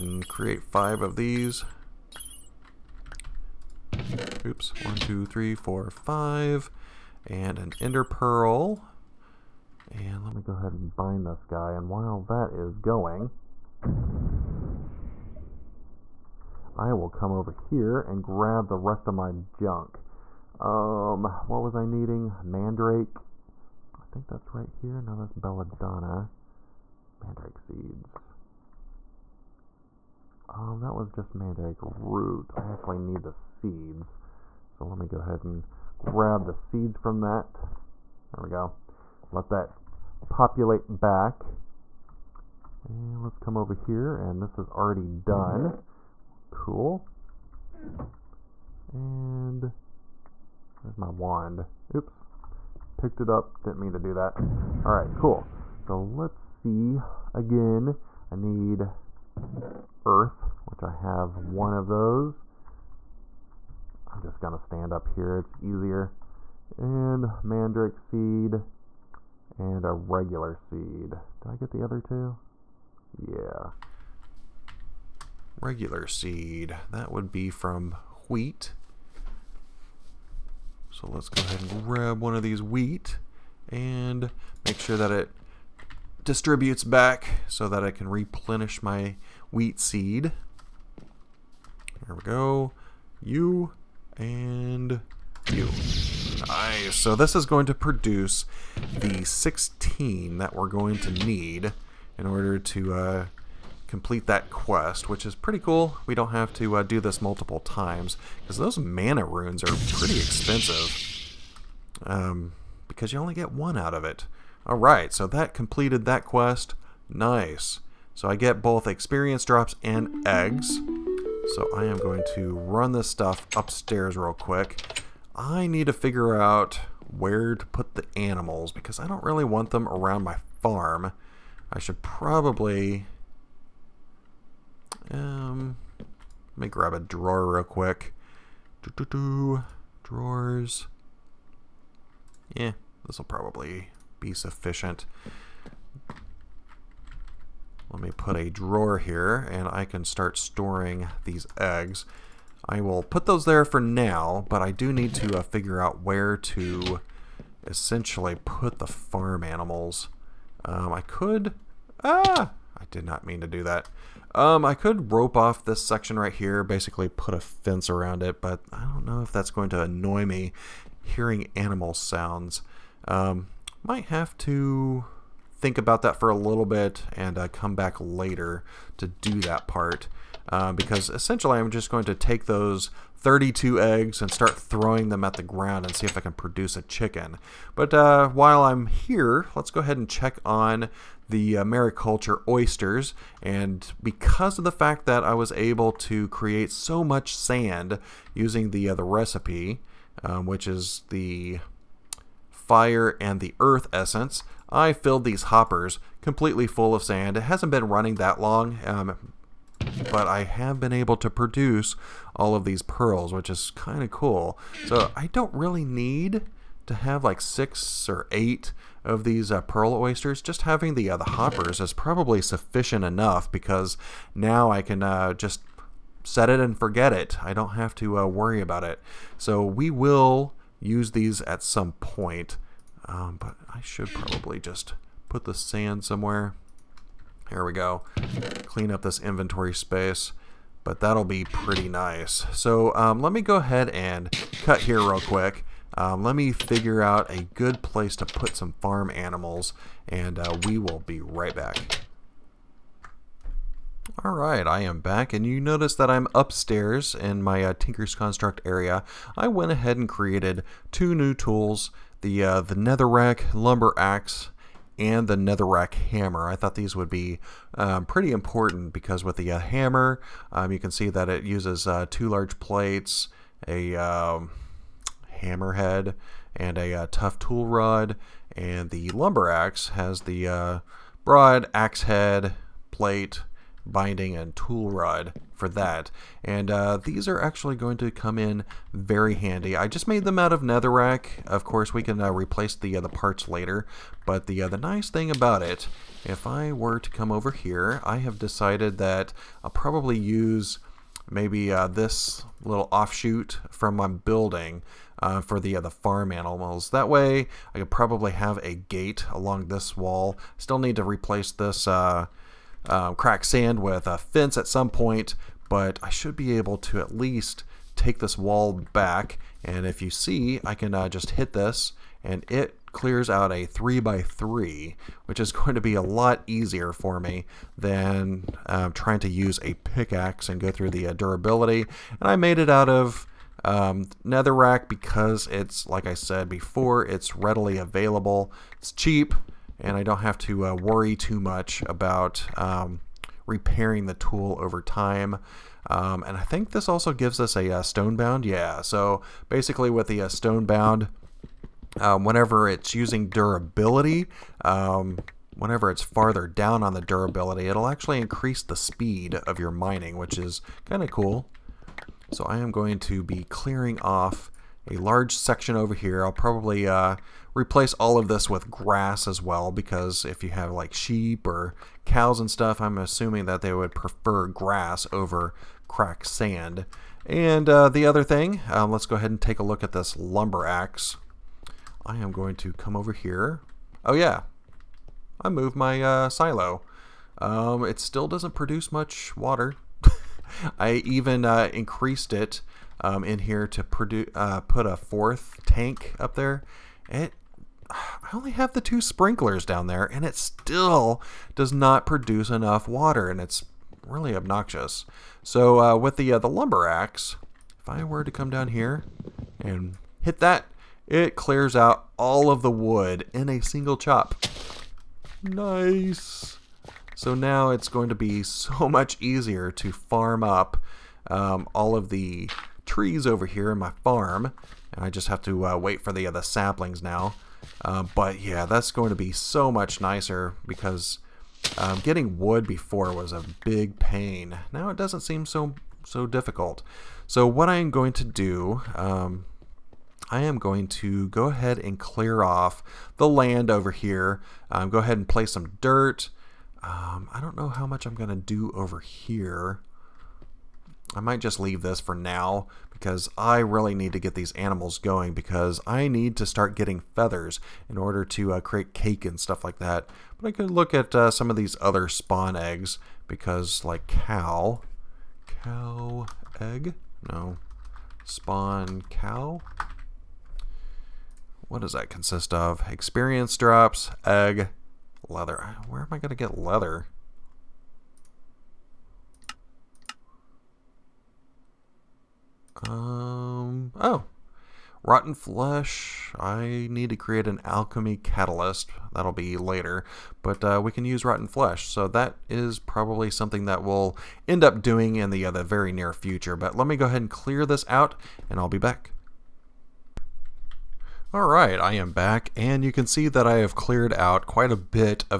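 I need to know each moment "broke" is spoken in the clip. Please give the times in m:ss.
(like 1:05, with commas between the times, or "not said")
not said.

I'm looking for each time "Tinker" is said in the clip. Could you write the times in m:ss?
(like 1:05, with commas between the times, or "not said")
4:17.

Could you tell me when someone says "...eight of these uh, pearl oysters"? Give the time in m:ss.
3:38.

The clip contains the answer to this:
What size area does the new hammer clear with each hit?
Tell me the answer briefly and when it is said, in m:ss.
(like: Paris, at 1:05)
3 by 3, at 5:23.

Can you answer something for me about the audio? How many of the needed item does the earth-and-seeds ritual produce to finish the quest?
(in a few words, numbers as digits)
16.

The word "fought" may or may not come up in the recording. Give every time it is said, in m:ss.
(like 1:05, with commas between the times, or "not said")
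not said.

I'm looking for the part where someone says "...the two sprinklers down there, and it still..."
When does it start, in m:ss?
6:38.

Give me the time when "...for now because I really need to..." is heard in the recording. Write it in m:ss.
7:32.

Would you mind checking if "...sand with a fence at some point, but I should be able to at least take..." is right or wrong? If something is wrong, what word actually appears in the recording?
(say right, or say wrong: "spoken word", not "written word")
right.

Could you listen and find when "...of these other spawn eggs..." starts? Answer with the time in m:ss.
7:41.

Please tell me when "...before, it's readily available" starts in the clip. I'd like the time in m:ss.
5:36.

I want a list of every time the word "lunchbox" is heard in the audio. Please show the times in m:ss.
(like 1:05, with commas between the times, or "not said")
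not said.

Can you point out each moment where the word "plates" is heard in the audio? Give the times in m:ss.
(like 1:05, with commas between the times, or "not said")
4:32, 4:42.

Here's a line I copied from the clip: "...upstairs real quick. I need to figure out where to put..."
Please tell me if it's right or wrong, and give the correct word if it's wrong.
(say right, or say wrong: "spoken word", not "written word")
right.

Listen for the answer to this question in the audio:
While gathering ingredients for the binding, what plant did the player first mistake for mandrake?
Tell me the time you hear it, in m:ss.
0:25.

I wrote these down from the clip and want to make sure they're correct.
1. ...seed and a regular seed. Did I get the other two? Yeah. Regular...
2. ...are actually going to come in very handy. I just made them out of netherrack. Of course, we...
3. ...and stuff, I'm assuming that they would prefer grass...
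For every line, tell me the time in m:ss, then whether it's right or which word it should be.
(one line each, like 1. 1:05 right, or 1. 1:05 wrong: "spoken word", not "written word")
1. 1:07 right
2. 4:47 right
3. 6:12 right.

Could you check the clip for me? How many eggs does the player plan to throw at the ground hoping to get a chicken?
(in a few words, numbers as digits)
32.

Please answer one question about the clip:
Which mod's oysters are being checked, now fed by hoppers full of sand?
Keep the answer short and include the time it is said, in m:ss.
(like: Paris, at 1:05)
Mariculture, at 3:11.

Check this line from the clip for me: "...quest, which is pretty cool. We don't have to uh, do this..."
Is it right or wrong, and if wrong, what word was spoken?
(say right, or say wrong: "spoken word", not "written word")
right.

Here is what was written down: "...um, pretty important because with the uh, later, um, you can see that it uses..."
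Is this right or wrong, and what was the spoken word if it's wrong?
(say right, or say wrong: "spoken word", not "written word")
wrong: "hammer", not "later".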